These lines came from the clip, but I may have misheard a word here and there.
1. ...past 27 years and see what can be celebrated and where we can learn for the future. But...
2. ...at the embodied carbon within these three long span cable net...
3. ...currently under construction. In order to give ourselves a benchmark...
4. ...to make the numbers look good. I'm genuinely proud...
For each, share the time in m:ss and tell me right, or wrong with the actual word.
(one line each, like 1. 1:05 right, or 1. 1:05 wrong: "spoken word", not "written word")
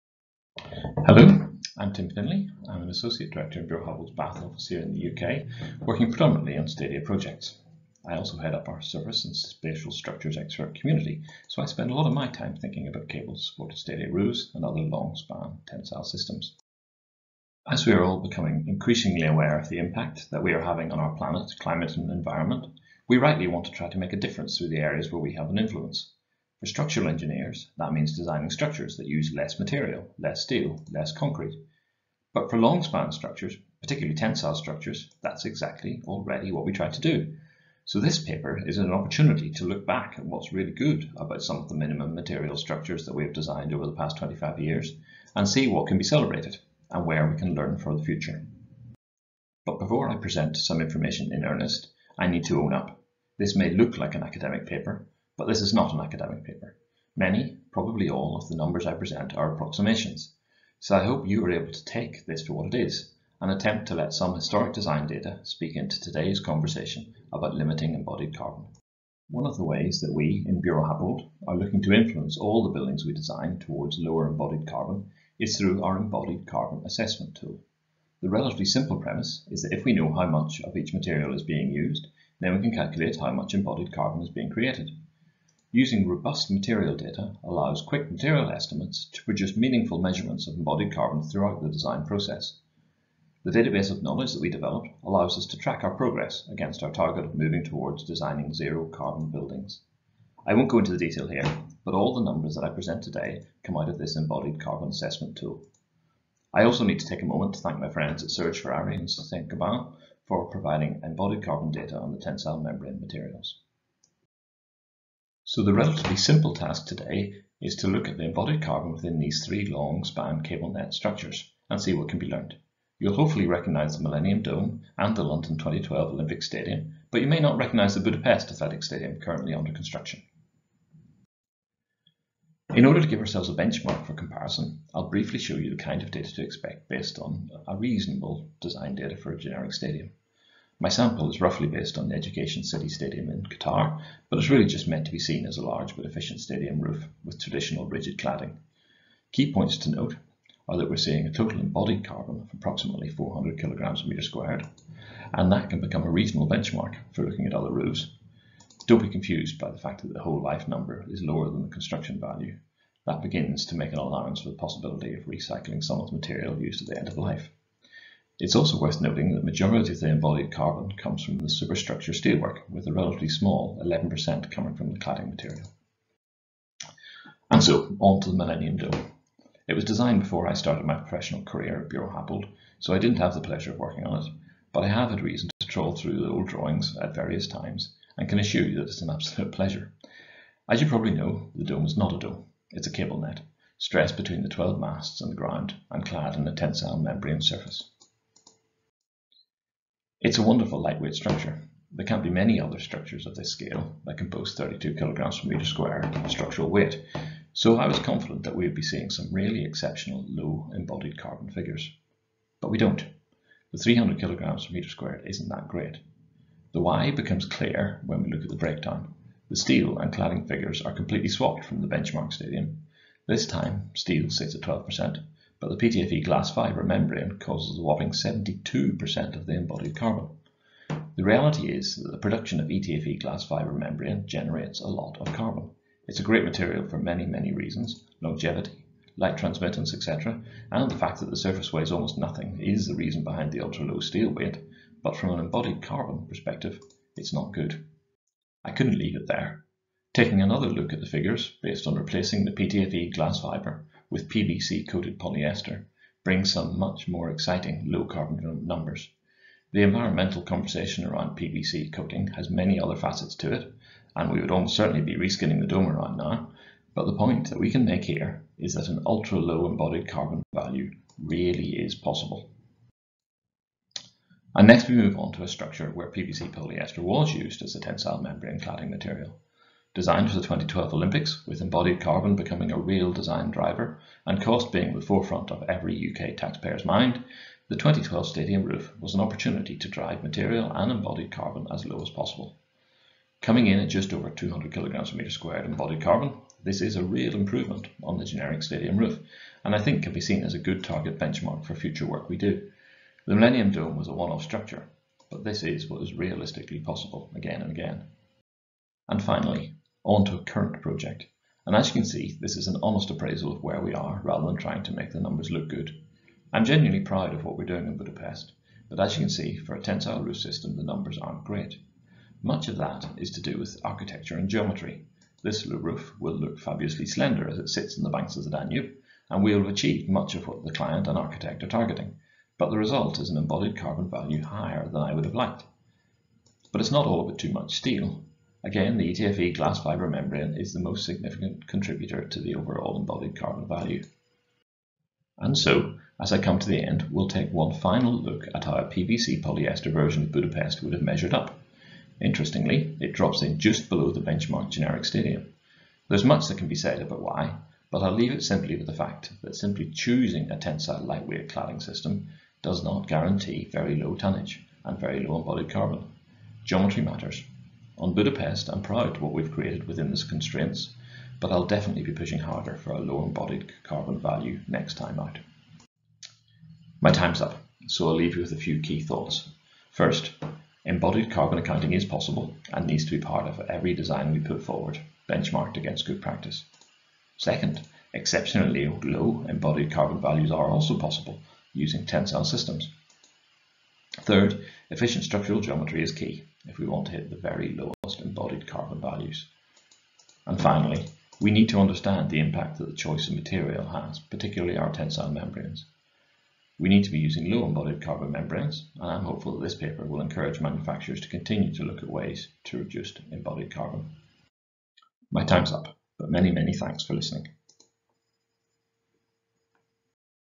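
1. 0:43 wrong: "25", not "27"
2. 1:58 right
3. 2:09 right
4. 5:14 right.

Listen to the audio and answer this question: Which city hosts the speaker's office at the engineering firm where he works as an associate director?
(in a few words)
Bath.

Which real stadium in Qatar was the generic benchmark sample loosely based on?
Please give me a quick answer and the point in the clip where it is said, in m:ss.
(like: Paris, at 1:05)
Education City Stadium, at 2:22.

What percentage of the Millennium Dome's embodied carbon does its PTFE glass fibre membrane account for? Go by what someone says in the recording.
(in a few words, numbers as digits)
72%.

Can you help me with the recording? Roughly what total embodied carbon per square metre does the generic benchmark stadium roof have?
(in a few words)
400 kg/m².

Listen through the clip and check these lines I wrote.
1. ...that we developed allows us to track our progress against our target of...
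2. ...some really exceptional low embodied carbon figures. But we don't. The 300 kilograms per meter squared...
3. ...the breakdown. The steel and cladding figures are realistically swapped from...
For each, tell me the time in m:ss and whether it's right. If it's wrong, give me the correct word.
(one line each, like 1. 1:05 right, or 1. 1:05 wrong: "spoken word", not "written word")
1. 1:34 right
2. 3:29 right
3. 3:38 wrong: "completely", not "realistically".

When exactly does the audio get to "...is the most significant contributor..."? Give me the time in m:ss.
5:40.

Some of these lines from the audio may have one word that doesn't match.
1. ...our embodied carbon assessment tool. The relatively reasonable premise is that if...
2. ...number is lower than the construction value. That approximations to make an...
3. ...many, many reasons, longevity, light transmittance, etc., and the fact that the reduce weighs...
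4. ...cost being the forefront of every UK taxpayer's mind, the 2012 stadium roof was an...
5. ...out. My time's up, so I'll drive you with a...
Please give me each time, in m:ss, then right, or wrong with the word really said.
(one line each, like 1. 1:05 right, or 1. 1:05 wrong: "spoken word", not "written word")
1. 1:15 wrong: "simple", not "reasonable"
2. 2:40 wrong: "begins", not "approximations"
3. 3:56 wrong: "surface", not "reduce"
4. 4:44 right
5. 6:15 wrong: "leave", not "drive".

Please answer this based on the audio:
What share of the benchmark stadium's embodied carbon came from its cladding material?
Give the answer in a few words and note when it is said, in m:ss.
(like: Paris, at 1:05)
11%, at 2:53.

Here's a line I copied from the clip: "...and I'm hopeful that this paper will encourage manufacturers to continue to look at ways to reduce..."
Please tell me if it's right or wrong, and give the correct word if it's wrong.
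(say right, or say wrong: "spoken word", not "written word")
right.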